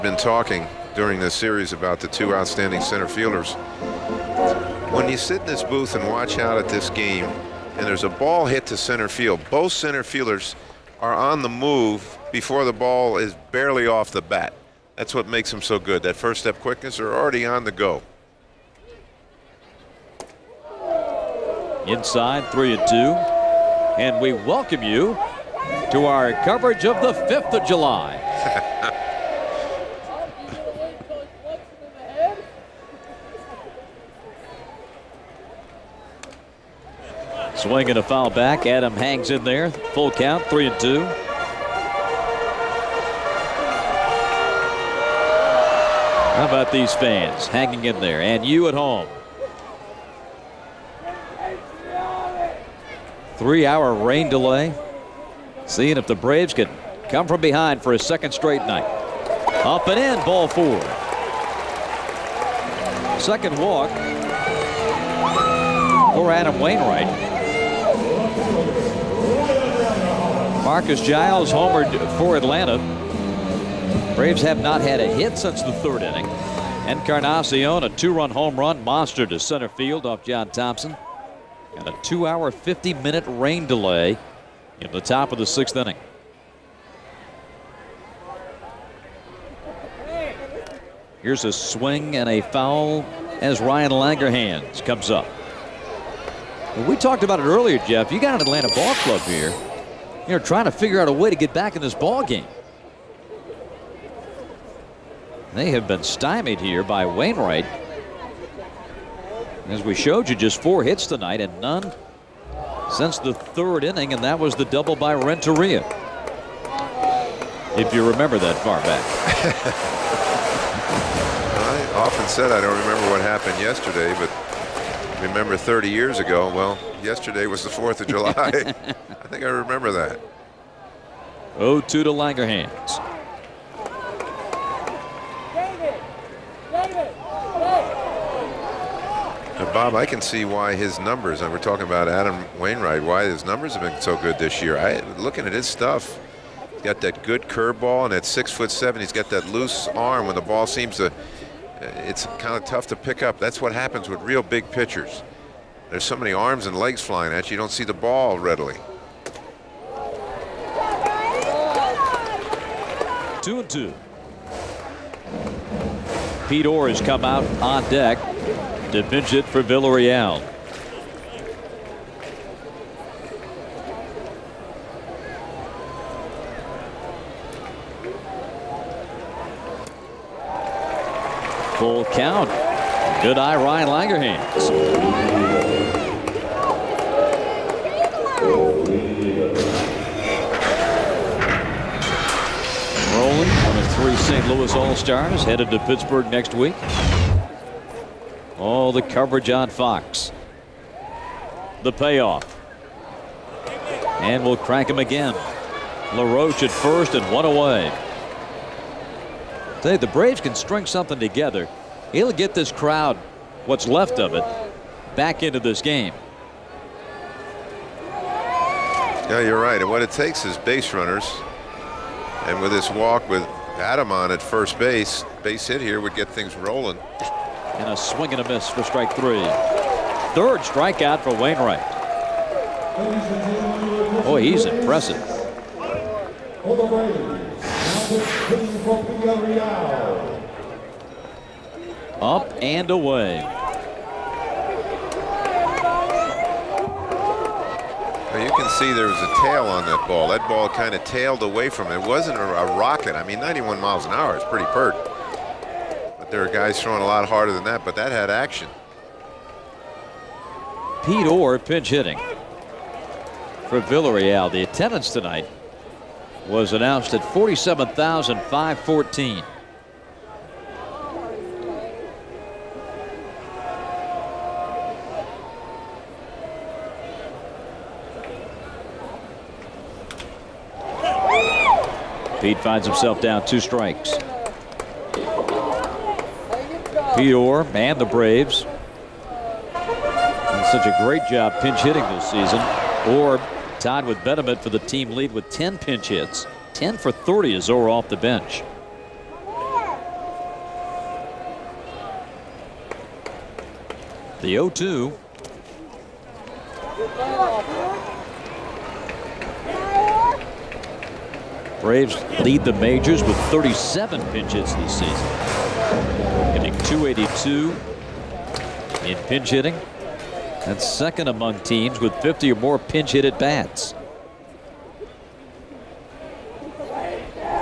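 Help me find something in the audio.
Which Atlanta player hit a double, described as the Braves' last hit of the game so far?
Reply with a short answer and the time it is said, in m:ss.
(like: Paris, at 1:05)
Renteria, at 1:55.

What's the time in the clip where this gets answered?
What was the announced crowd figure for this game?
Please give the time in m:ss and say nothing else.
4:27.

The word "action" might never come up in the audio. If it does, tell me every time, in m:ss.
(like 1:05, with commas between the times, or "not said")
4:18.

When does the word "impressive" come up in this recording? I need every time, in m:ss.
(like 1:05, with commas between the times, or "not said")
3:54.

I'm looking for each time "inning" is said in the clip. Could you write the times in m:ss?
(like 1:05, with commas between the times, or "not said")
1:16, 1:25, 1:53.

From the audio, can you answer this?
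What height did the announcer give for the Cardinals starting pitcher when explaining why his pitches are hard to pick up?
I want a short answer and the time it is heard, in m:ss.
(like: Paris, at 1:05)
6 foot 7, at 2:28.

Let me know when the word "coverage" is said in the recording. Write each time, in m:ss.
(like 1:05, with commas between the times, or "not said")
0:26, 3:19.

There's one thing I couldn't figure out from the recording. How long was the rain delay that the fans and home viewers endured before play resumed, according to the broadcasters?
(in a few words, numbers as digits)
3 hours.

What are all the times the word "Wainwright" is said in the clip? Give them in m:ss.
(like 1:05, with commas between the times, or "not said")
1:06, 1:47, 2:22, 3:51.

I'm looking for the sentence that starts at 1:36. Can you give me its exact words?
Well, we talked about it earlier, Jeff.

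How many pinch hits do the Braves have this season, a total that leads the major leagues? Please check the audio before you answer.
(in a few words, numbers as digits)
37.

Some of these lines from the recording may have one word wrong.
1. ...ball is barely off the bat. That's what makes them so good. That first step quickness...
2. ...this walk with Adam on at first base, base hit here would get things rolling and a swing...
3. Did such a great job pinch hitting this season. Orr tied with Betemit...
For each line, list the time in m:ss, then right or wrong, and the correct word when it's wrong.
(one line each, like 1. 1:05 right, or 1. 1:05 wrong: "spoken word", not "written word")
1. 0:12 right
2. 3:42 right
3. 4:48 right.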